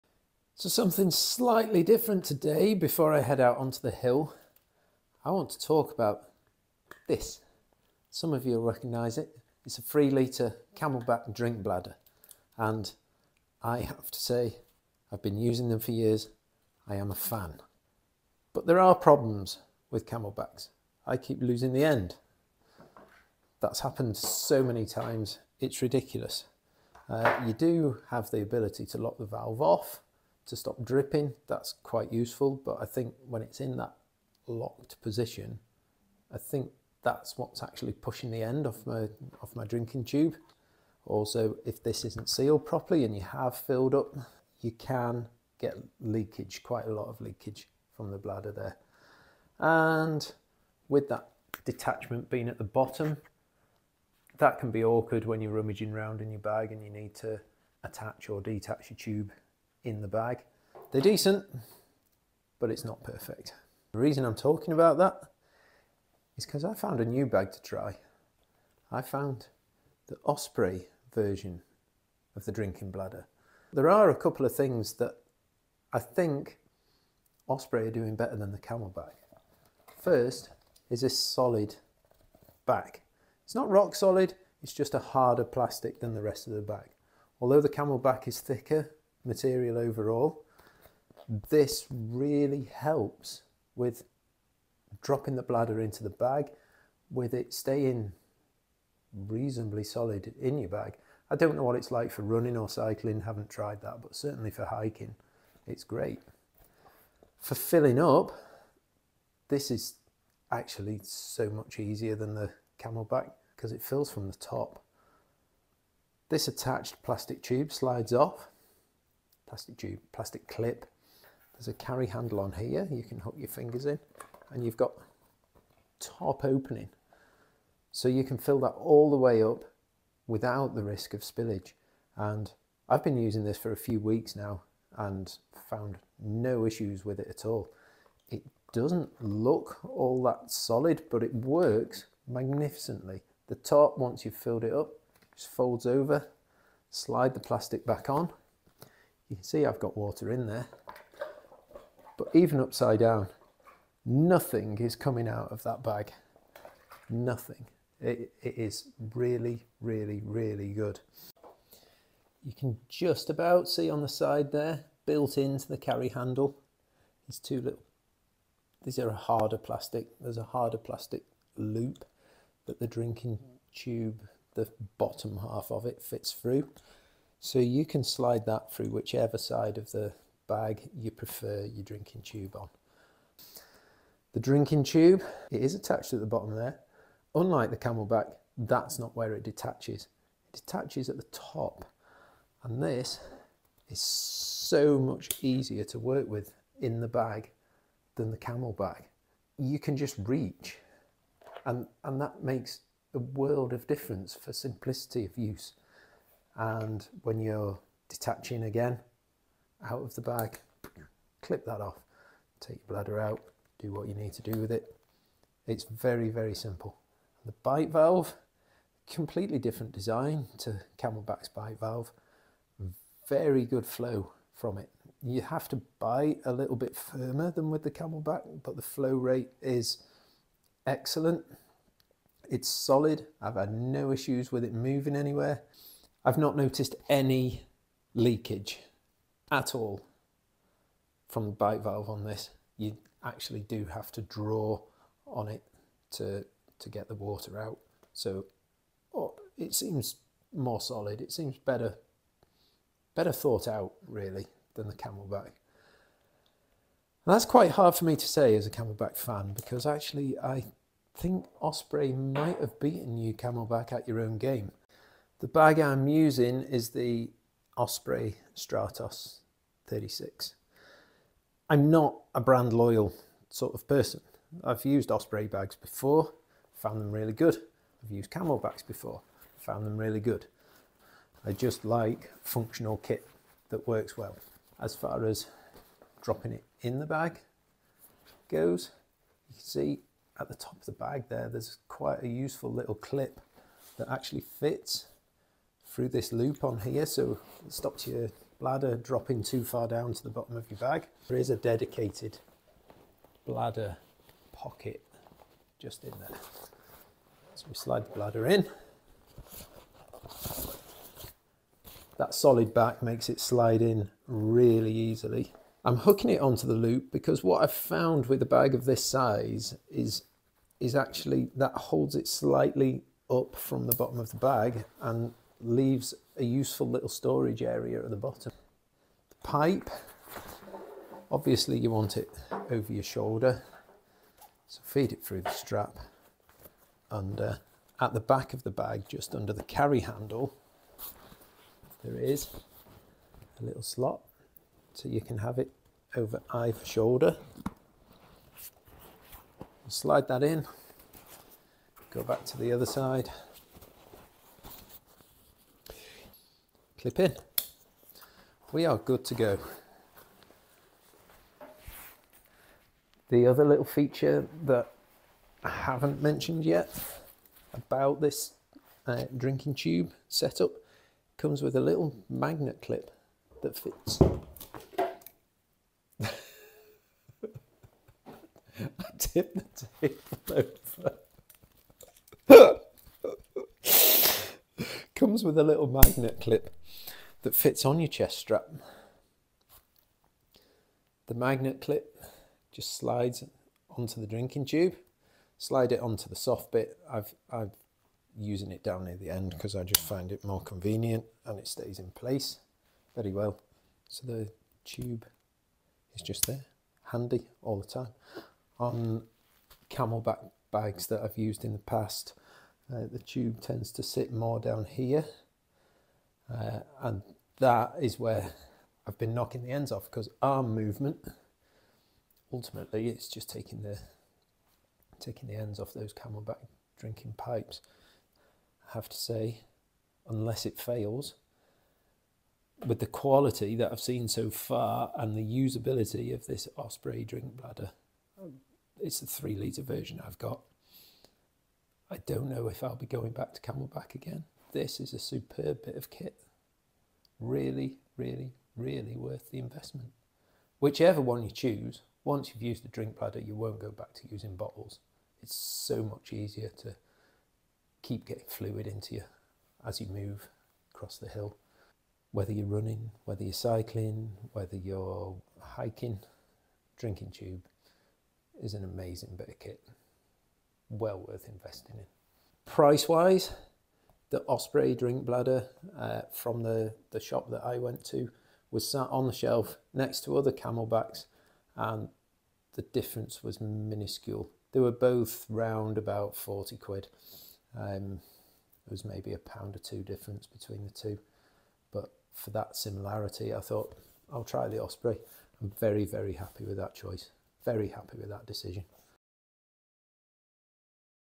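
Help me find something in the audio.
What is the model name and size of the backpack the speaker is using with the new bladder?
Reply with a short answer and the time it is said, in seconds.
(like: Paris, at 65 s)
Stratos 36, at 268 s.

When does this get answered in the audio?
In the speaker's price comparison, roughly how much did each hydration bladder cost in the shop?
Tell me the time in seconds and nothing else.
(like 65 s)
486 s.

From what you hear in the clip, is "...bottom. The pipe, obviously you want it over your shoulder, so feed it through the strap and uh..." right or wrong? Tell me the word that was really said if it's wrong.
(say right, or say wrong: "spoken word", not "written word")
right.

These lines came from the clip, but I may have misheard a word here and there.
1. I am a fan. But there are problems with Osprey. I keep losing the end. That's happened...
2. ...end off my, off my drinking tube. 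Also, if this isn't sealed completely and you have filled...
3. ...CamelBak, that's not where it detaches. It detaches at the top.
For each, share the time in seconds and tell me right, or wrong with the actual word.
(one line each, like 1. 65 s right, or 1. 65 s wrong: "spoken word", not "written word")
1. 16 s wrong: "CamelBaks", not "Osprey"
2. 38 s wrong: "properly", not "completely"
3. 187 s right.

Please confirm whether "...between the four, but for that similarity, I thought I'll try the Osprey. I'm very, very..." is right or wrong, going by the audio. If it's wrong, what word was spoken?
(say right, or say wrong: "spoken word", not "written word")
wrong: "two", not "four".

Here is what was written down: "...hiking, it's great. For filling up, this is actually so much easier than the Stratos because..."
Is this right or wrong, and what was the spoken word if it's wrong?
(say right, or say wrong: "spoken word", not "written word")
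wrong: "CamelBak", not "Stratos".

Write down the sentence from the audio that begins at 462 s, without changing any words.
Whether you're running, whether you're cycling, whether you're hiking, drinking tube is an amazing bit of kit well worth investing in.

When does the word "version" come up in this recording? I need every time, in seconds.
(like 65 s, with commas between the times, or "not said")
71 s, 439 s.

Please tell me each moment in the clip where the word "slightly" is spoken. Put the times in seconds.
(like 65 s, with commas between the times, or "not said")
1 s, 322 s.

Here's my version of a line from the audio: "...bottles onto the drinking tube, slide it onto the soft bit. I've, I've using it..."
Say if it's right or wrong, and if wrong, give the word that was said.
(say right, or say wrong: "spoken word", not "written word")
wrong: "slides", not "bottles".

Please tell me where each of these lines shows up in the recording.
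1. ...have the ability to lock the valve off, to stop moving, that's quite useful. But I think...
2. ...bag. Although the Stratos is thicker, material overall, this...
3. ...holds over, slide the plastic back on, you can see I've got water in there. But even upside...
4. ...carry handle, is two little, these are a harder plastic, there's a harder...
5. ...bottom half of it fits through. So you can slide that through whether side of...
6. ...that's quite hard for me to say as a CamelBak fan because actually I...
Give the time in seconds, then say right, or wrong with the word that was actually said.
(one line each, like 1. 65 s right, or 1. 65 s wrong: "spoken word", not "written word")
1. 28 s wrong: "dripping", not "moving"
2. 86 s wrong: "CamelBak", not "Stratos"
3. 145 s wrong: "folds", not "holds"
4. 165 s right
5. 174 s wrong: "whichever", not "whether"
6. 257 s right.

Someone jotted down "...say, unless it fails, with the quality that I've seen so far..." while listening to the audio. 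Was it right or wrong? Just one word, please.
right.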